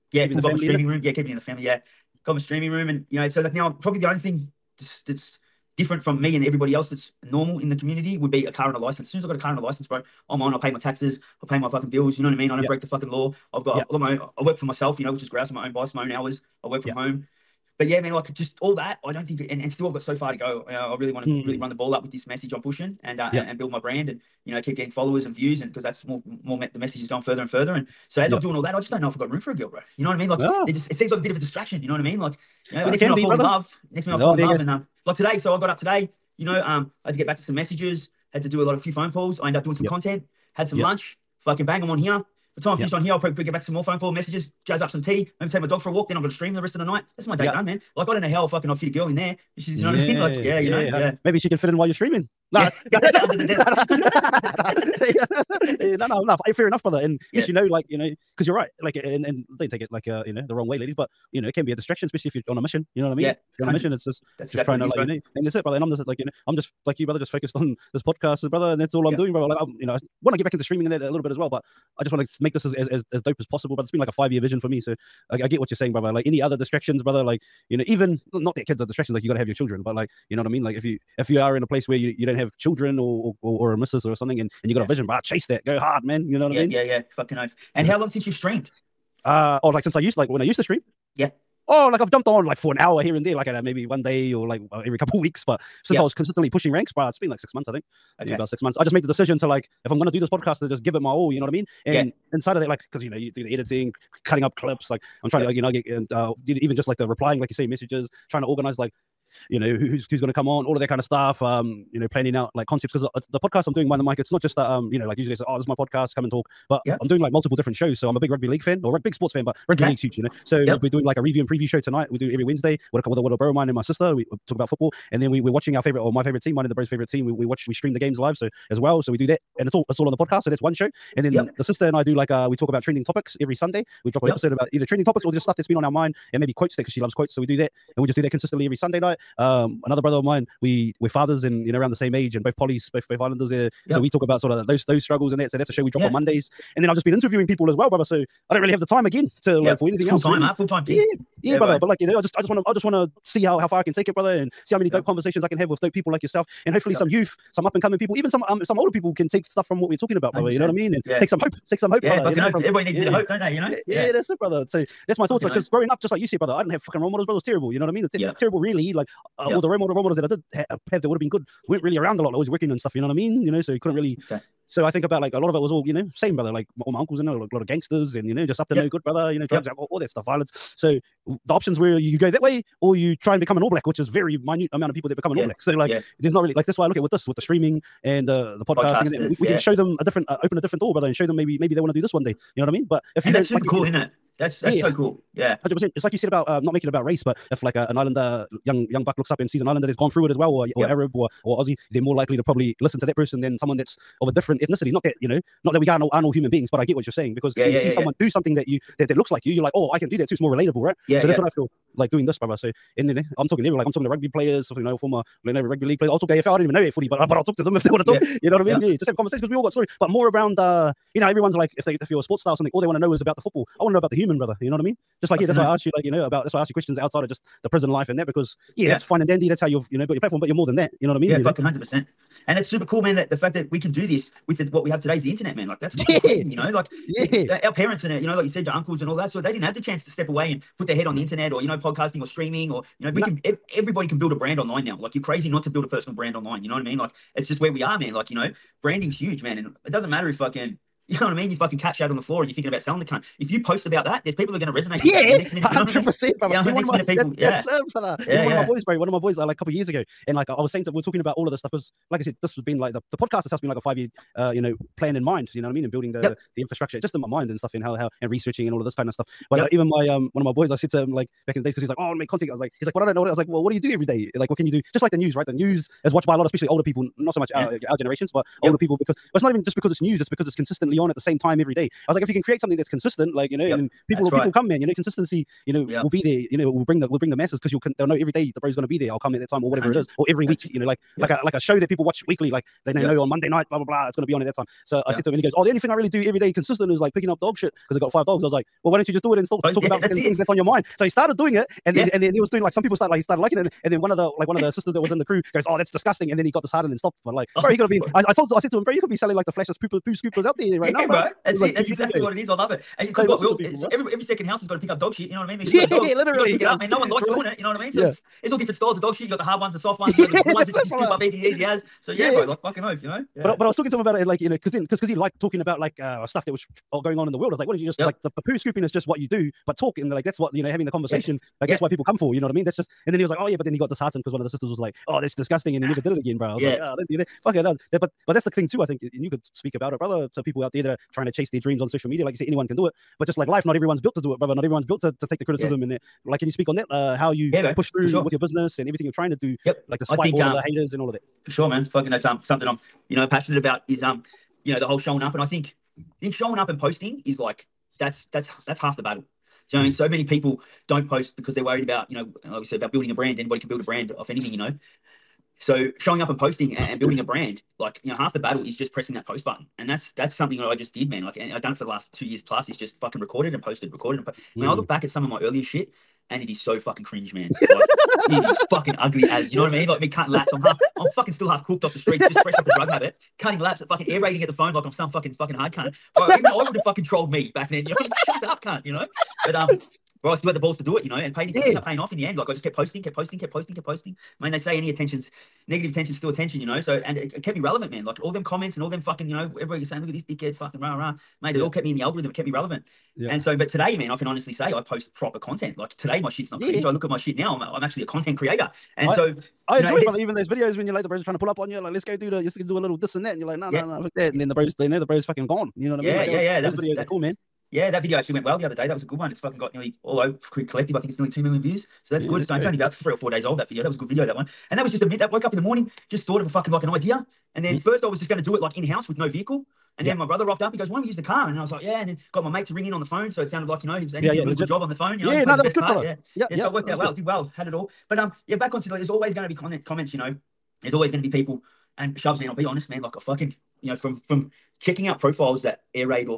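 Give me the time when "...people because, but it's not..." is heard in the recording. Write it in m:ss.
4:38.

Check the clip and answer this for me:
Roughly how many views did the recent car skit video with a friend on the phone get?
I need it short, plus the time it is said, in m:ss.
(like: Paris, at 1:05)
2 million, at 7:01.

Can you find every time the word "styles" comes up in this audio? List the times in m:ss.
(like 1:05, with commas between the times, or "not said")
5:18.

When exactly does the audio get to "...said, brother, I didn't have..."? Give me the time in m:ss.
2:46.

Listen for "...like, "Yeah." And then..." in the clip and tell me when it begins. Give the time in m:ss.
7:11.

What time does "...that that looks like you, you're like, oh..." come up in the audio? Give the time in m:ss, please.
3:28.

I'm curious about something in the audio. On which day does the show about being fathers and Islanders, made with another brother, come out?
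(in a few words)
Mondays.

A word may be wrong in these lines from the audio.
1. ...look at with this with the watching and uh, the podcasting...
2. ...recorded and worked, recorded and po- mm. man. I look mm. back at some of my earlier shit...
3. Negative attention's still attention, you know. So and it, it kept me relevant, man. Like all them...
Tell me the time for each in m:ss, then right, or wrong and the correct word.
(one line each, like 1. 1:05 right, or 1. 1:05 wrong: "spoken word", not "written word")
1. 3:06 wrong: "streaming", not "watching"
2. 6:13 wrong: "posted", not "worked"
3. 6:35 right.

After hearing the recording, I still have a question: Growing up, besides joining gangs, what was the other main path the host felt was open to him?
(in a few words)
Become an All Black.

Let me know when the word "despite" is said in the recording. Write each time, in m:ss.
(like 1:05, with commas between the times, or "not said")
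5:49.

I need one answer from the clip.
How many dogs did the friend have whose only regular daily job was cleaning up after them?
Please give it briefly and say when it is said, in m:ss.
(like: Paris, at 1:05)
5, at 4:58.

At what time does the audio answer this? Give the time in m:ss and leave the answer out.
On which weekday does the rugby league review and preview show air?
2:02.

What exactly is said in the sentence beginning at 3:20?
Arab or or Aussie, they're more likely to probably listen to that person than someone that's of a different ethnicity.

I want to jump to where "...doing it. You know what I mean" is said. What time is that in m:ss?
5:17.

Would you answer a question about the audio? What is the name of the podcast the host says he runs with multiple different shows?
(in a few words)
Mind the Mic.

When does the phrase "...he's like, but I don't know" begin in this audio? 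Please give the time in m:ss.
4:32.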